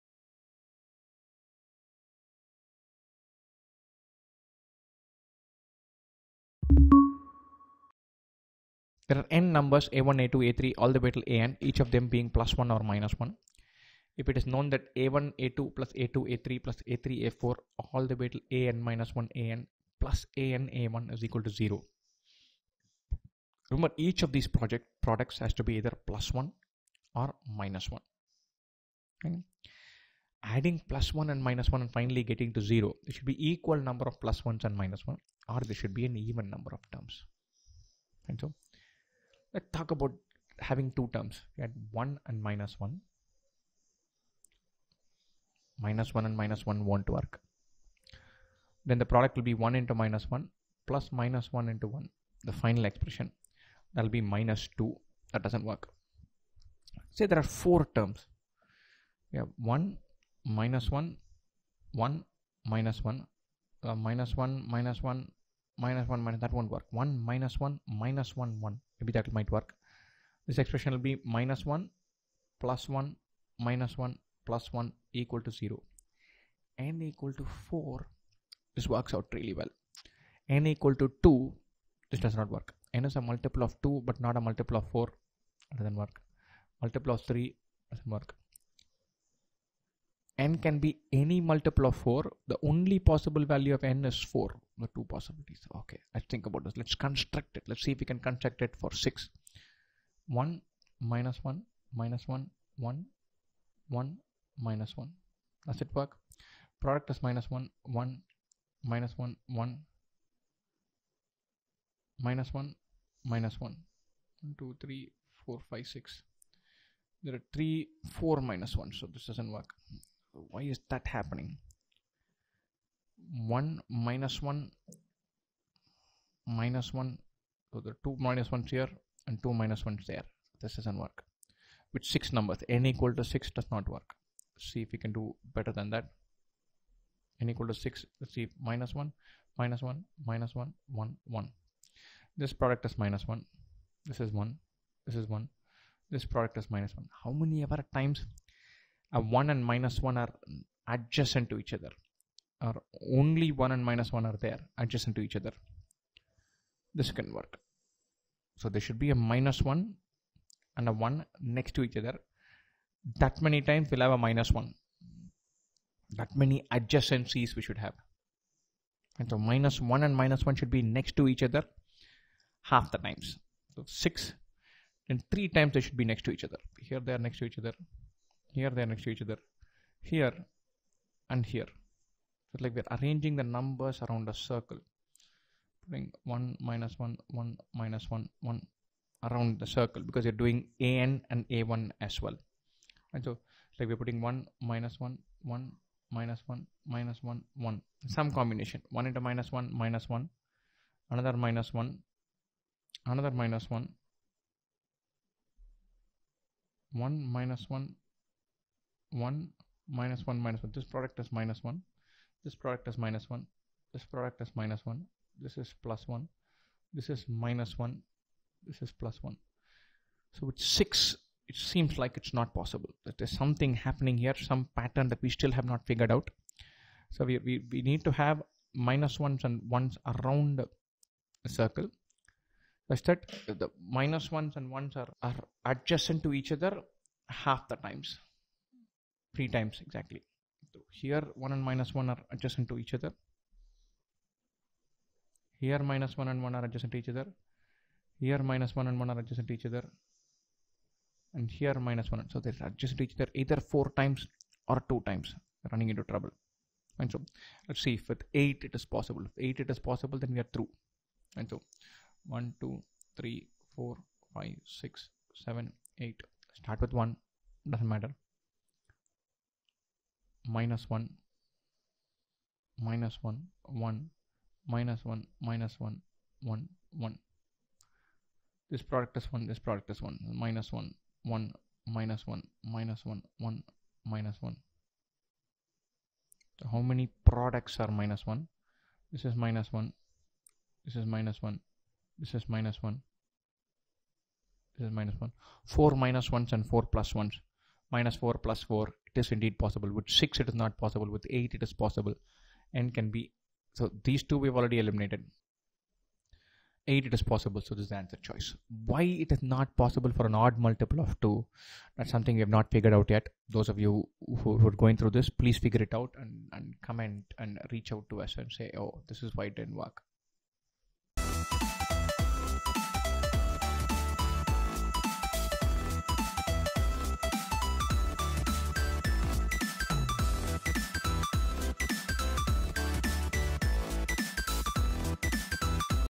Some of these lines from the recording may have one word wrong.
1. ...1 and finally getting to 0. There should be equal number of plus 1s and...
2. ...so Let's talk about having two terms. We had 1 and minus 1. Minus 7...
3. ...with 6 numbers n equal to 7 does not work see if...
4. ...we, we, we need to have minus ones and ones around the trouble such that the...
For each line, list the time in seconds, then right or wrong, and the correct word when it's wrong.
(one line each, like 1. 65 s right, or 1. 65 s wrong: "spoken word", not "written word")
1. 31 s right
2. 38 s wrong: "1", not "7"
3. 131 s wrong: "6", not "7"
4. 227 s wrong: "circle", not "trouble".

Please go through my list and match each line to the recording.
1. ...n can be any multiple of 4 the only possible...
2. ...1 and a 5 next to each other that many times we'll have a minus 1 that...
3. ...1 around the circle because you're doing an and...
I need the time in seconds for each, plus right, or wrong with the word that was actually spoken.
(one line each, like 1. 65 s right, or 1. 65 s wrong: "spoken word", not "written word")
1. 90 s right
2. 159 s wrong: "1", not "5"
3. 188 s right.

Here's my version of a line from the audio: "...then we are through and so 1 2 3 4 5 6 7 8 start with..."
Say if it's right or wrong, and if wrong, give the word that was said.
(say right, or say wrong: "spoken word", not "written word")
right.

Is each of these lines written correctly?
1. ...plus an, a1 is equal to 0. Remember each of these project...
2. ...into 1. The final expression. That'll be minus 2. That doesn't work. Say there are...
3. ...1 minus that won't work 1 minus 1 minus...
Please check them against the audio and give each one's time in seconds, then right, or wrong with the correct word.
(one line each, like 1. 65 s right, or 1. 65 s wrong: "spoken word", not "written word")
1. 19 s right
2. 51 s right
3. 66 s right.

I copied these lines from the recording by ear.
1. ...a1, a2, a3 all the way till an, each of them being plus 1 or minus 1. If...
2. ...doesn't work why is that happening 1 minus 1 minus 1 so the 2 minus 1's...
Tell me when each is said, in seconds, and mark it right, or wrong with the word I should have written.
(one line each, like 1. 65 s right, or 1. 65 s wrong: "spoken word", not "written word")
1. 9 s right
2. 119 s right.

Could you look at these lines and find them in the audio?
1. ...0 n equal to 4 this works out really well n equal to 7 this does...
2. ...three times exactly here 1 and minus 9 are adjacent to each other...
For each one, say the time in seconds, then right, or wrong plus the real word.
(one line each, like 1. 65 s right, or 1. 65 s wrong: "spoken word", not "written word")
1. 75 s wrong: "2", not "7"
2. 239 s wrong: "1", not "9".